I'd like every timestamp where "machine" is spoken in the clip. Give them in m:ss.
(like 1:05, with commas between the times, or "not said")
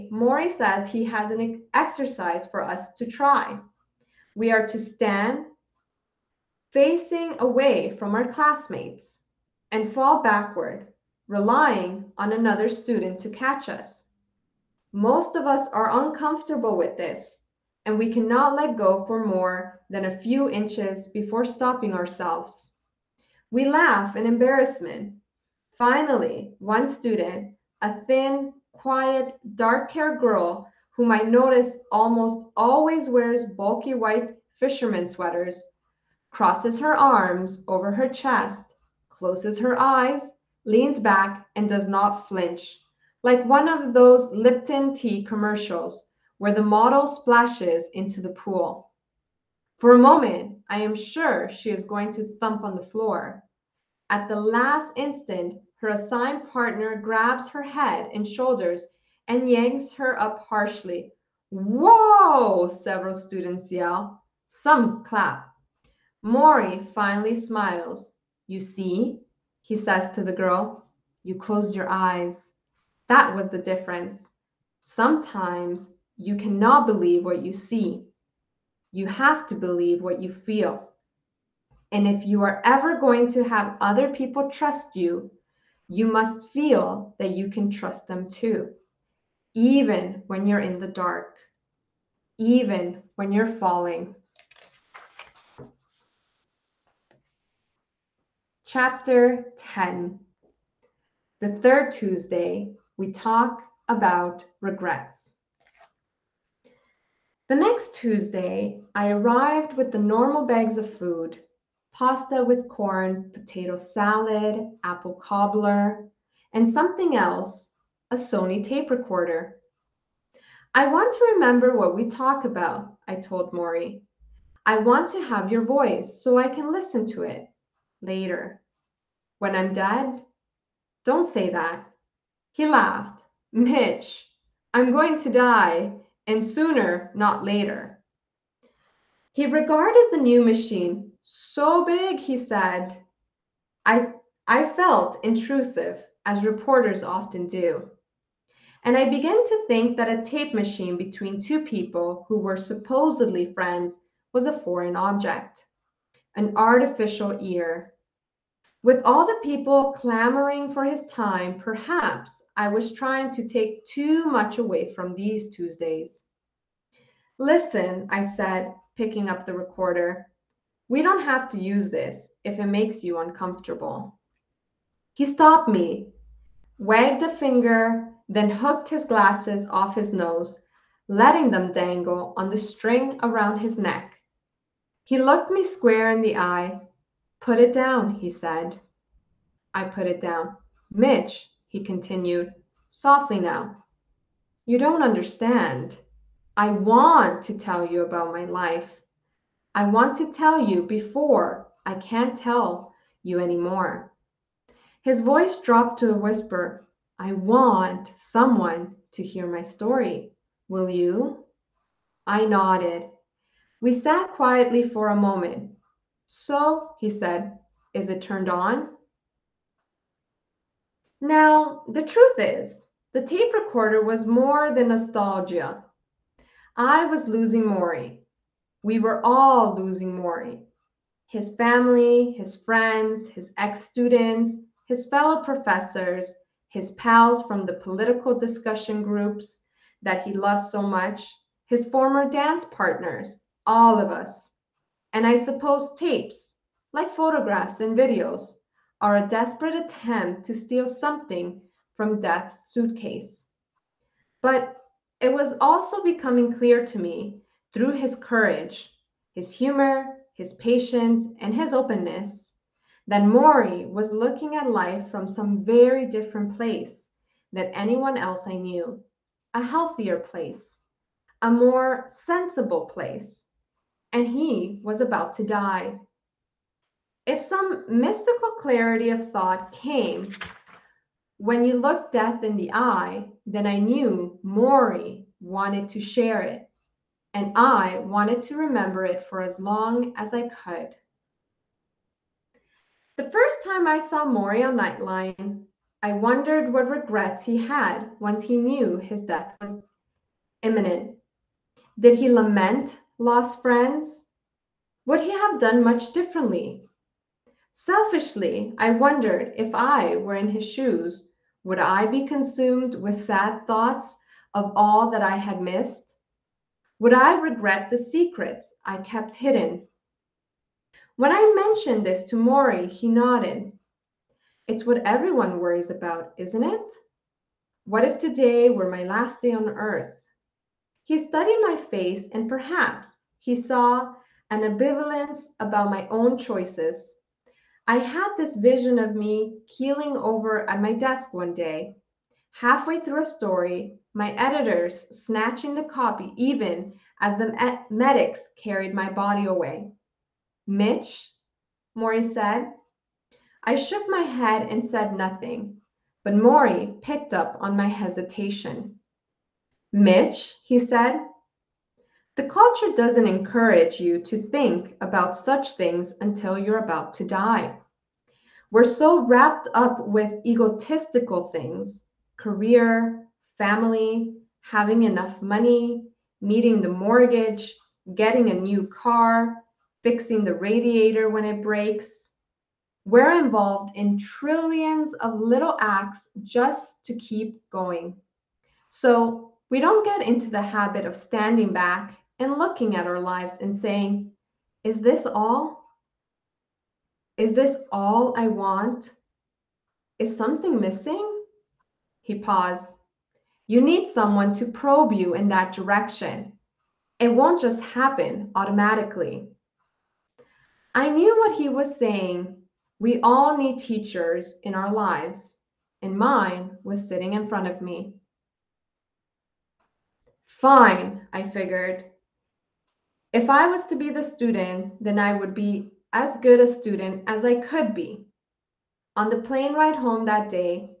2:20, 2:30.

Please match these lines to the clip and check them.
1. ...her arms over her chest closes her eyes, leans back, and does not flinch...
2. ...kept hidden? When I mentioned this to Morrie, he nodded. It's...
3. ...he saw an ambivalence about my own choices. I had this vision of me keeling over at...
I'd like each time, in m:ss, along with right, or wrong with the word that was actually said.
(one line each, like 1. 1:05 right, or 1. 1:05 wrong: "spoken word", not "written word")
1. 0:36 right
2. 5:18 right
3. 5:33 right.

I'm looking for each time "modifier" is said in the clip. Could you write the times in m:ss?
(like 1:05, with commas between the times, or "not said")
not said.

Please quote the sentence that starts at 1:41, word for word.
The third Tuesday, we talk about regrets.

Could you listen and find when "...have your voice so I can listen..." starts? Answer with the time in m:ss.
2:05.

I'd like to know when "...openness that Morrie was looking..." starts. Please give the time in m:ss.
4:21.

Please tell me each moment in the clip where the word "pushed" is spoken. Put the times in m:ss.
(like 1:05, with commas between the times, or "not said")
not said.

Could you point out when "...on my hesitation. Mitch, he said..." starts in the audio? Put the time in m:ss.
5:57.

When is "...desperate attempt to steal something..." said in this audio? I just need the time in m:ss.
4:09.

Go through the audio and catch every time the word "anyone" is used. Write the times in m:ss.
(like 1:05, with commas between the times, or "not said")
4:27.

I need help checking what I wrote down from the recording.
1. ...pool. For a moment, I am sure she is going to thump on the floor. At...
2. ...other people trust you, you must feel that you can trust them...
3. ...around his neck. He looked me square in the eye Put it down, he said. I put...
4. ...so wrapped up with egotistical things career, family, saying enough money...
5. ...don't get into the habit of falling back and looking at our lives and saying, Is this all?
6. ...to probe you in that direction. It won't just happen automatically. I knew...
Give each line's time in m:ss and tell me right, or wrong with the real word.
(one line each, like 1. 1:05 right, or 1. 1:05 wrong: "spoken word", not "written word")
1. 0:48 right
2. 1:23 right
3. 3:03 right
4. 6:08 wrong: "having", not "saying"
5. 6:29 wrong: "standing", not "falling"
6. 6:44 right.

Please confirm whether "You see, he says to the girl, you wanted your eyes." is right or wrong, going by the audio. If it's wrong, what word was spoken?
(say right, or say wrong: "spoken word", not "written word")
wrong: "closed", not "wanted".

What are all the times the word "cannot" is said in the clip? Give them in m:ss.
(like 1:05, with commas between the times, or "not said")
0:18, 1:16.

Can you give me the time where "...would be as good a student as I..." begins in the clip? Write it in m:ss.
7:05.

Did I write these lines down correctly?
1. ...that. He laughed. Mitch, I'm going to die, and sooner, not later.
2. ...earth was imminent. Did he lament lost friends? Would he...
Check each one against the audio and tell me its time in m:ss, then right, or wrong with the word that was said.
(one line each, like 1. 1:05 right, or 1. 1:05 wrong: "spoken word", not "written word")
1. 2:11 right
2. 4:59 wrong: "death", not "earth".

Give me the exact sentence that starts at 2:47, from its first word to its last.
Listen, I said, picking up the recorder.